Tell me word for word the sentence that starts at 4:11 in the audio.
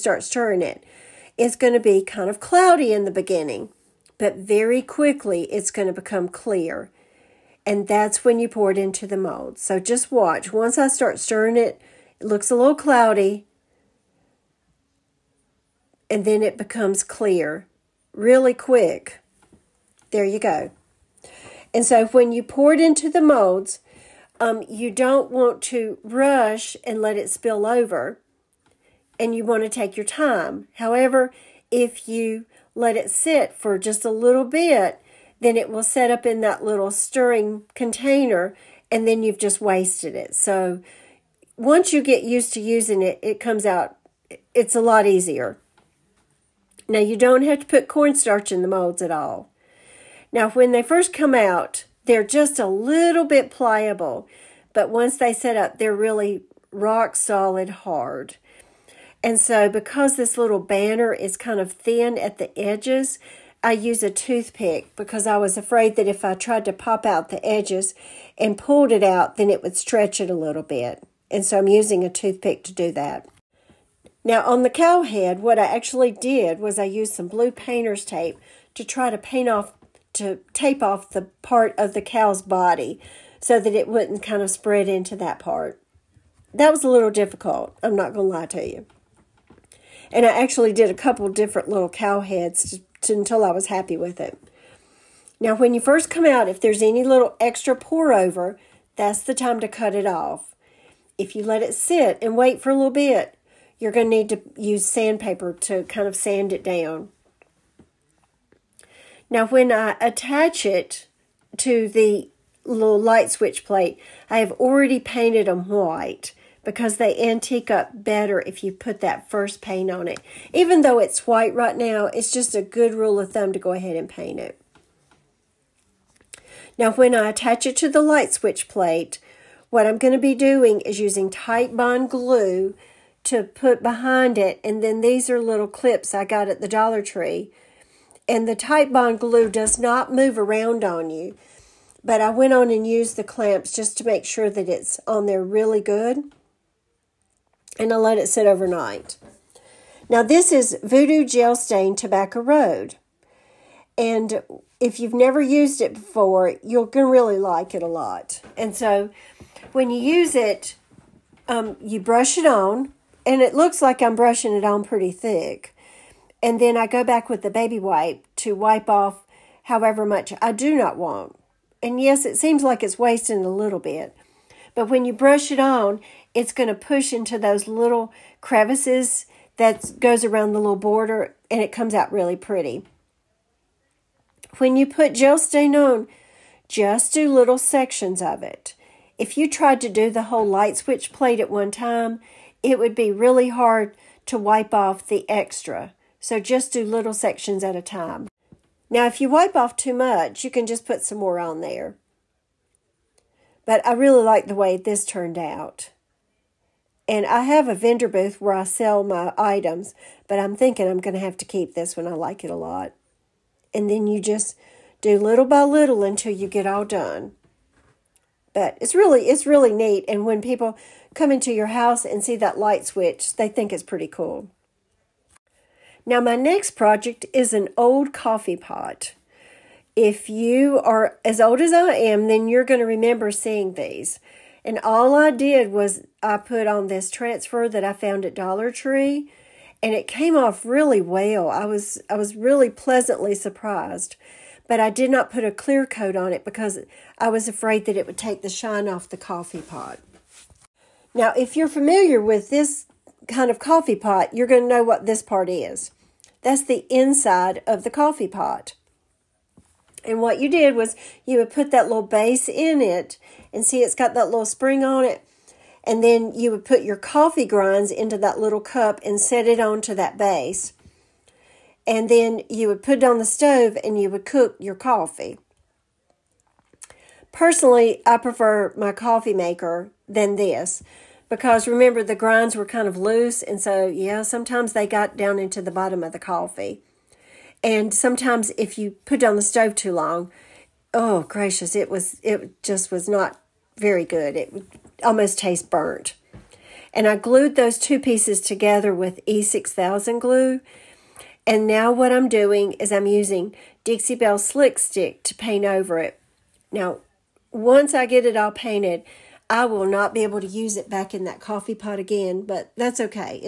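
Now, if you're familiar with this kind of coffee pot, you're going to know what this part is.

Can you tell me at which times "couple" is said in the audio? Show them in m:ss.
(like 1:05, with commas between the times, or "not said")
1:30.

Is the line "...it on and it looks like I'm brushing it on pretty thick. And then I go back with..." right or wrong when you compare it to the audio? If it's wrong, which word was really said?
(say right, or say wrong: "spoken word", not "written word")
right.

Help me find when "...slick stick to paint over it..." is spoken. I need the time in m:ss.
5:04.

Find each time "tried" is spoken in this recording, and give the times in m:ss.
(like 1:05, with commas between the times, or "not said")
1:06, 3:09.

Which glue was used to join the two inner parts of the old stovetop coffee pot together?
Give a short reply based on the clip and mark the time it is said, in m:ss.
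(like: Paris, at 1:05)
E6000, at 4:59.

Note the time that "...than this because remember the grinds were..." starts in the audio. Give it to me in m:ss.
4:40.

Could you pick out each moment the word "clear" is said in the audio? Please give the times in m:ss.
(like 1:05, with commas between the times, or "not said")
0:06, 0:17, 4:05.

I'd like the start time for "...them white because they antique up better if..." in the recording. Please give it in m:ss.
1:55.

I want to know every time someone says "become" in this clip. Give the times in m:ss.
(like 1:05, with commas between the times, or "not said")
0:05, 0:16.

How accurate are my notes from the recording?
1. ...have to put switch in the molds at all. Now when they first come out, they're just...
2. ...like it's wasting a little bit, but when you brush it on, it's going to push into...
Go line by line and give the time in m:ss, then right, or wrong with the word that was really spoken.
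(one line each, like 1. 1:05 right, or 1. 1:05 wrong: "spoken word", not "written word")
1. 0:47 wrong: "cornstarch", not "switch"
2. 2:52 right.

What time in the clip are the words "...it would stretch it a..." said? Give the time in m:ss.
1:09.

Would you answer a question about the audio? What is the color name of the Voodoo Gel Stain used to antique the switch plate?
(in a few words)
Tobacco Road.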